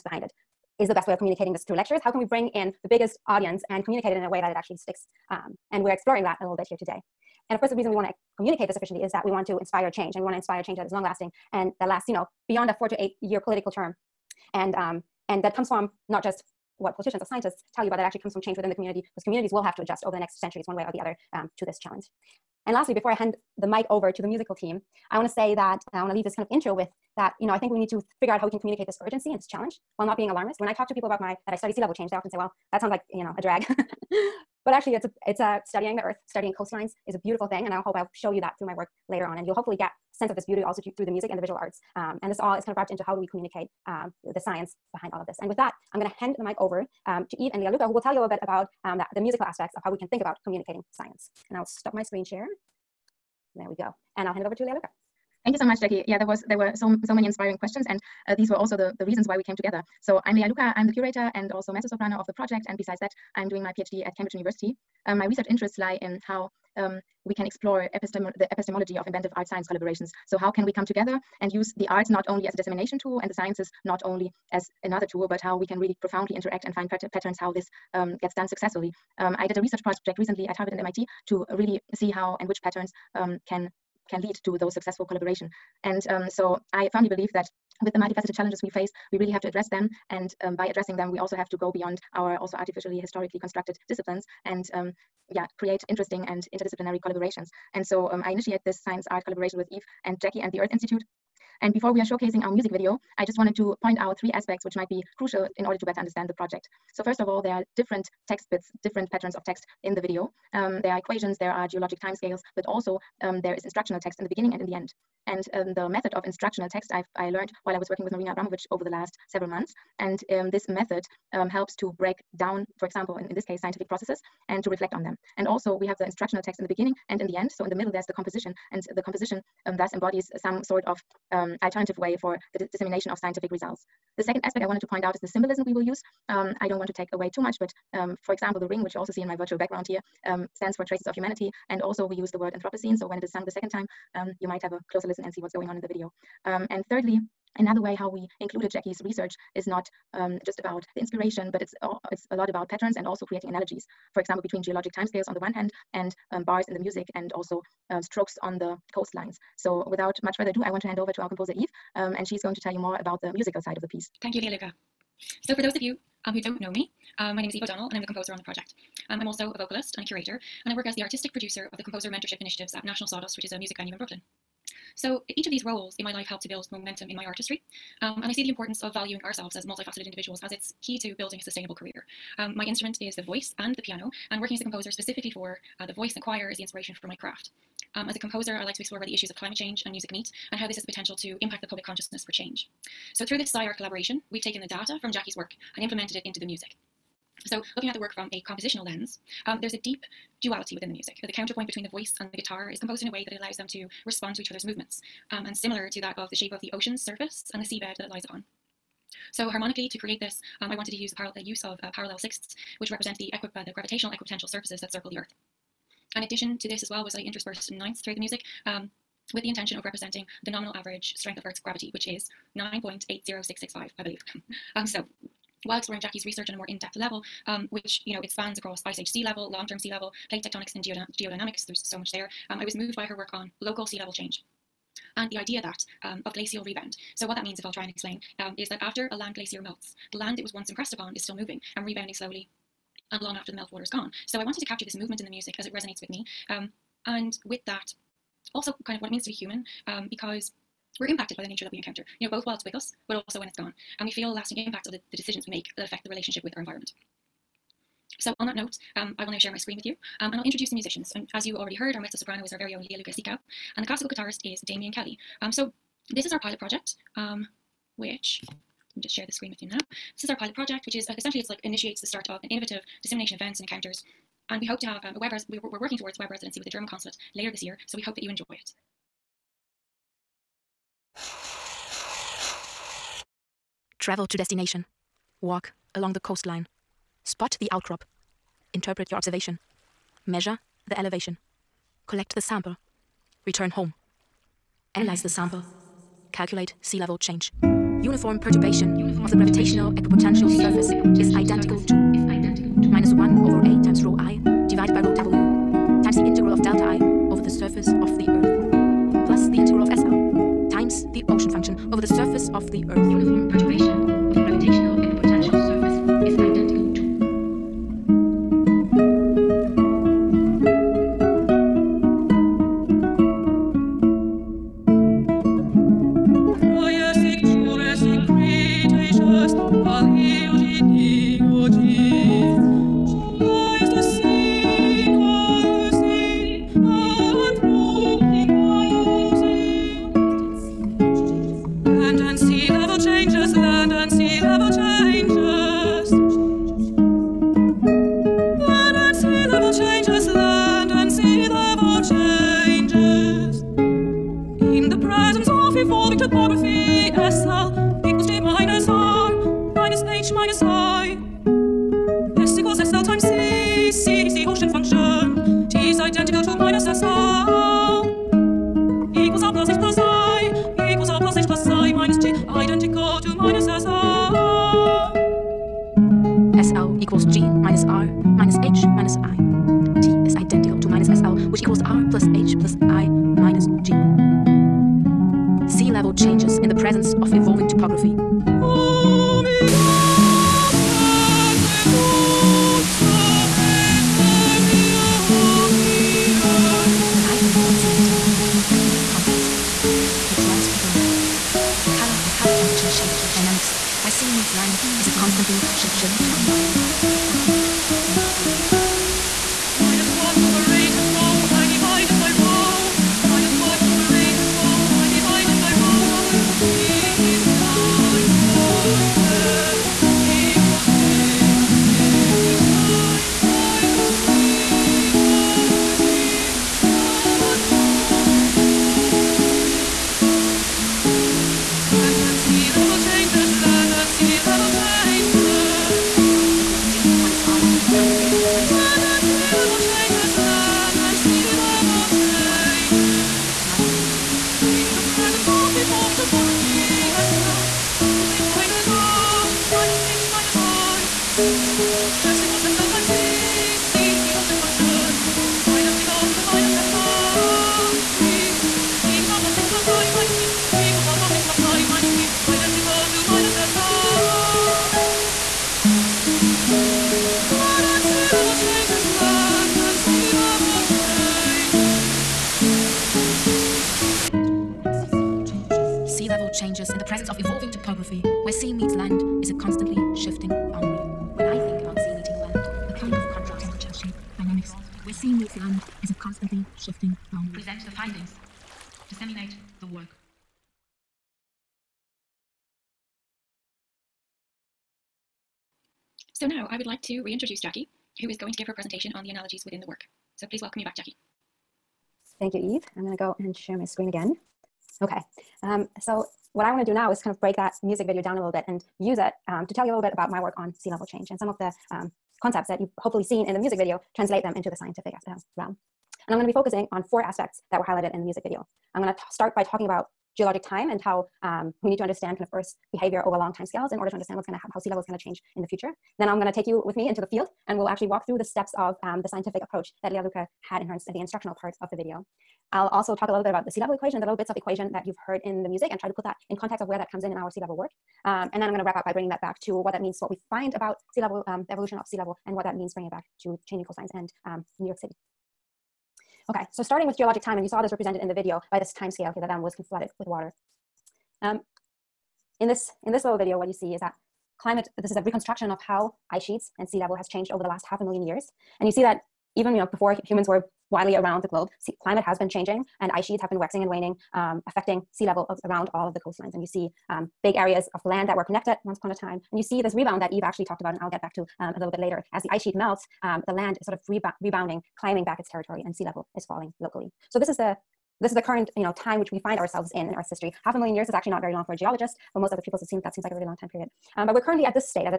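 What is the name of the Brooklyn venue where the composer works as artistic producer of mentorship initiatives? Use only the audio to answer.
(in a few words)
National Sawdust.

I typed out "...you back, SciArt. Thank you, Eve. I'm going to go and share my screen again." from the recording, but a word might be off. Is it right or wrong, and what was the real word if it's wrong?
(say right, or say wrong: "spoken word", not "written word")
wrong: "Jacky", not "SciArt".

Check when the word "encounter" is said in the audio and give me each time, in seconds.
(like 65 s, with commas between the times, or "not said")
251 s, 273 s.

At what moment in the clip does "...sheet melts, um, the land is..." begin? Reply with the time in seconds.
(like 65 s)
572 s.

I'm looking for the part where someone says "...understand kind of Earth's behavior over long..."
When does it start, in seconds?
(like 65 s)
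522 s.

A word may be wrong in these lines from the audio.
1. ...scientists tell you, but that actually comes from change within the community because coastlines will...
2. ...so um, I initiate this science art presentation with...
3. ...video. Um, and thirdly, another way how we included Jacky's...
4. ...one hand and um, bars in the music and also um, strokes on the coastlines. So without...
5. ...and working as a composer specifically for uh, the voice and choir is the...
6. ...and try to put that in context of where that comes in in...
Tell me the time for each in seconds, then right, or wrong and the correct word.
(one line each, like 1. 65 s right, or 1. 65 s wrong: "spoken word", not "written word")
1. 17 s wrong: "communities", not "coastlines"
2. 97 s wrong: "collaboration", not "presentation"
3. 145 s right
4. 155 s right
5. 184 s right
6. 535 s right.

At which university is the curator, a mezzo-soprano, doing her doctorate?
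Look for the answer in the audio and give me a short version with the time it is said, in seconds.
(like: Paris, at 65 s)
Cambridge University, at 64 s.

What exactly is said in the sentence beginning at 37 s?
And I hope I'll show you that through my work later on.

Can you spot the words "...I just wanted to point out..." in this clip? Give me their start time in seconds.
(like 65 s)
103 s.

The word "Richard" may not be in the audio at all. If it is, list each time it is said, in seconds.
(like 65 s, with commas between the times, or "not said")
not said.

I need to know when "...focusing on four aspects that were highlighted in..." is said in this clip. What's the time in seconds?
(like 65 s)
516 s.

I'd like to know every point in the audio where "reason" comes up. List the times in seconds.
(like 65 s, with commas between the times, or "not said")
7 s, 59 s.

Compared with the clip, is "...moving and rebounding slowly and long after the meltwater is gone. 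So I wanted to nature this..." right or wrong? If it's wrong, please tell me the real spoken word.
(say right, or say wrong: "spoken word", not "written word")
wrong: "capture", not "nature".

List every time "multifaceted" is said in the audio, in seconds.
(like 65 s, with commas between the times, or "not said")
87 s, 179 s.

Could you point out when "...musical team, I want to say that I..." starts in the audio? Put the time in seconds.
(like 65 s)
24 s.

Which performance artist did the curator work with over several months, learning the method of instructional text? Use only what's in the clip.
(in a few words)
Marina Abramovich.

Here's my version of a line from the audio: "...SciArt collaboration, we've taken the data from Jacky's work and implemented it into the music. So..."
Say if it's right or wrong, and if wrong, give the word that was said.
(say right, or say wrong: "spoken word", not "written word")
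right.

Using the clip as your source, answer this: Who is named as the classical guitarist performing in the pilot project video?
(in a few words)
Damien Kelly.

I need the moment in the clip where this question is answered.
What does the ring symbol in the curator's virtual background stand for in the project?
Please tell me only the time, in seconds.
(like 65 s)
140 s.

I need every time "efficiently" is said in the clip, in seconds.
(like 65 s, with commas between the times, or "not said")
8 s.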